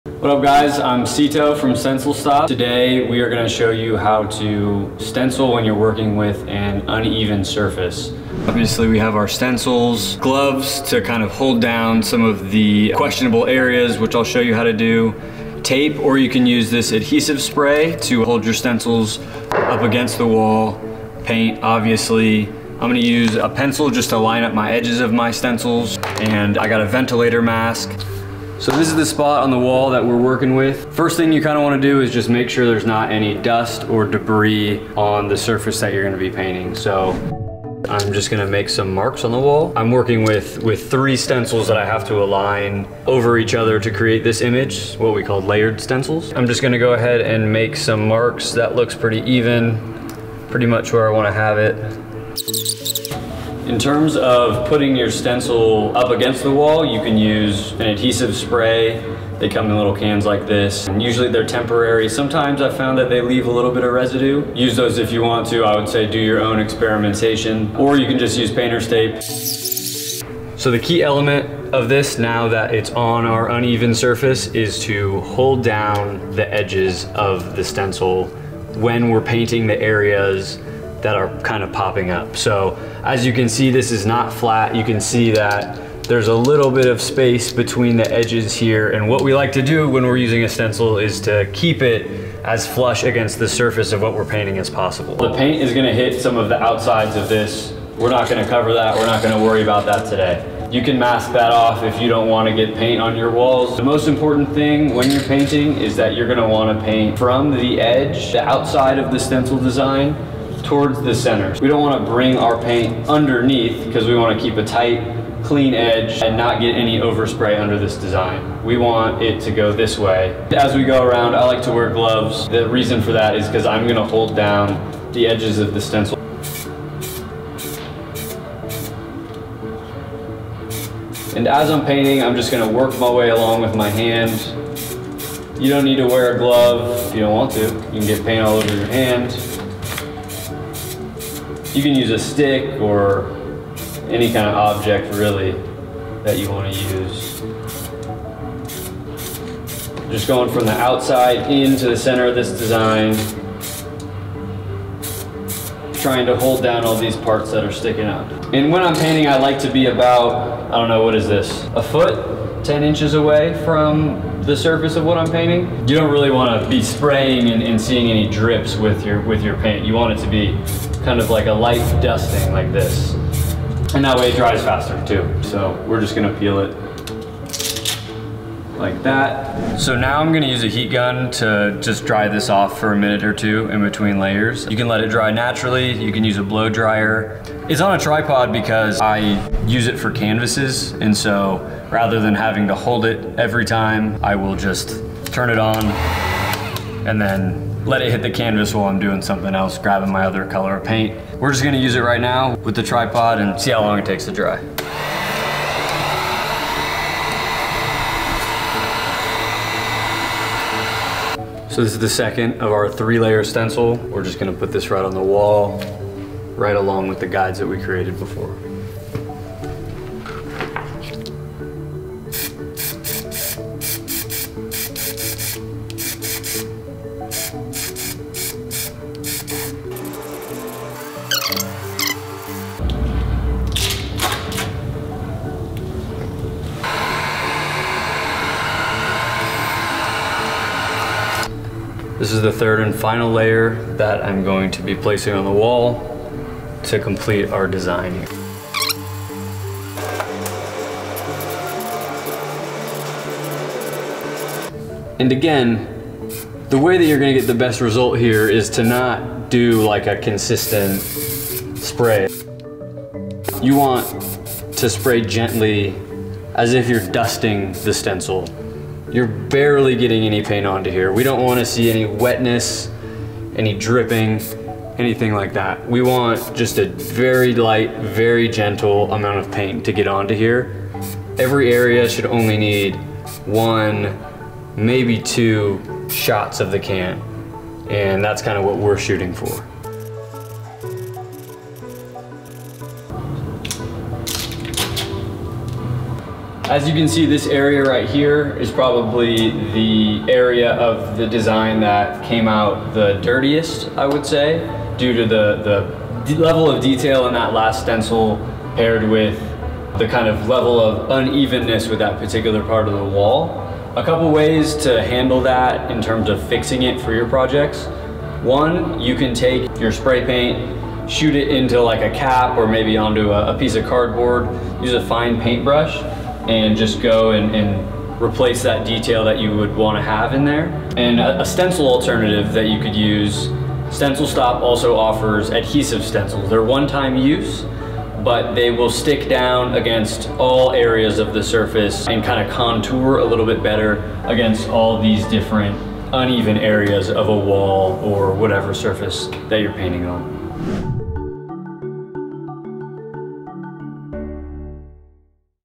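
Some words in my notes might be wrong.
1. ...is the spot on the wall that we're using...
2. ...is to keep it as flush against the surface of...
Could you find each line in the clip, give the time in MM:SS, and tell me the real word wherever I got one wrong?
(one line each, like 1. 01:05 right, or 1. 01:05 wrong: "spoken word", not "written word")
1. 00:28 wrong: "working", not "using"
2. 01:30 right.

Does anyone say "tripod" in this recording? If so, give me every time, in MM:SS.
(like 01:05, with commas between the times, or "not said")
03:08, 03:22.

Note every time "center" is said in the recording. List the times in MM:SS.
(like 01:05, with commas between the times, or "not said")
01:51, 02:31.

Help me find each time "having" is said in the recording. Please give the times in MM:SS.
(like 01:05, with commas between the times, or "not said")
03:12.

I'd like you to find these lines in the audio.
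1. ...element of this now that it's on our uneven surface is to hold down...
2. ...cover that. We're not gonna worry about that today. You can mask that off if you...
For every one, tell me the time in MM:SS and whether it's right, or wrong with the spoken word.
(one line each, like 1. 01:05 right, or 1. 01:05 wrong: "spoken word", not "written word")
1. 01:11 right
2. 01:38 right.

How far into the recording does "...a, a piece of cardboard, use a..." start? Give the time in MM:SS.
05:23.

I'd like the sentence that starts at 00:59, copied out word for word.
They come in little cans like this.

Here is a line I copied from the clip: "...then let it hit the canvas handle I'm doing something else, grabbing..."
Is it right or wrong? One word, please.
wrong.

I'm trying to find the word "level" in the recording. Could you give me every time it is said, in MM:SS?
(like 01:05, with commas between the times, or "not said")
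05:06, 05:10.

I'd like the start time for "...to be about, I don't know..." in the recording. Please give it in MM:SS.
02:39.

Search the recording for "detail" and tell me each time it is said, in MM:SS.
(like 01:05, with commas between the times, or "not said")
05:06, 05:28.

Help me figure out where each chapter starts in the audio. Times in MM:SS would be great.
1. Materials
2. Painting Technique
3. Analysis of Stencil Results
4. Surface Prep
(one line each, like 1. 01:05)
1. 00:10
2. 01:10
3. 04:55
4. 00:27.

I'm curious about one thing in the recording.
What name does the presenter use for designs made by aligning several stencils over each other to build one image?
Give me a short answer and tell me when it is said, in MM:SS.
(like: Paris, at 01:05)
layered stencils, at 00:45.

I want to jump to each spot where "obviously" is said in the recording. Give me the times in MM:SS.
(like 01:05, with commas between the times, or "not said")
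00:08, 00:21.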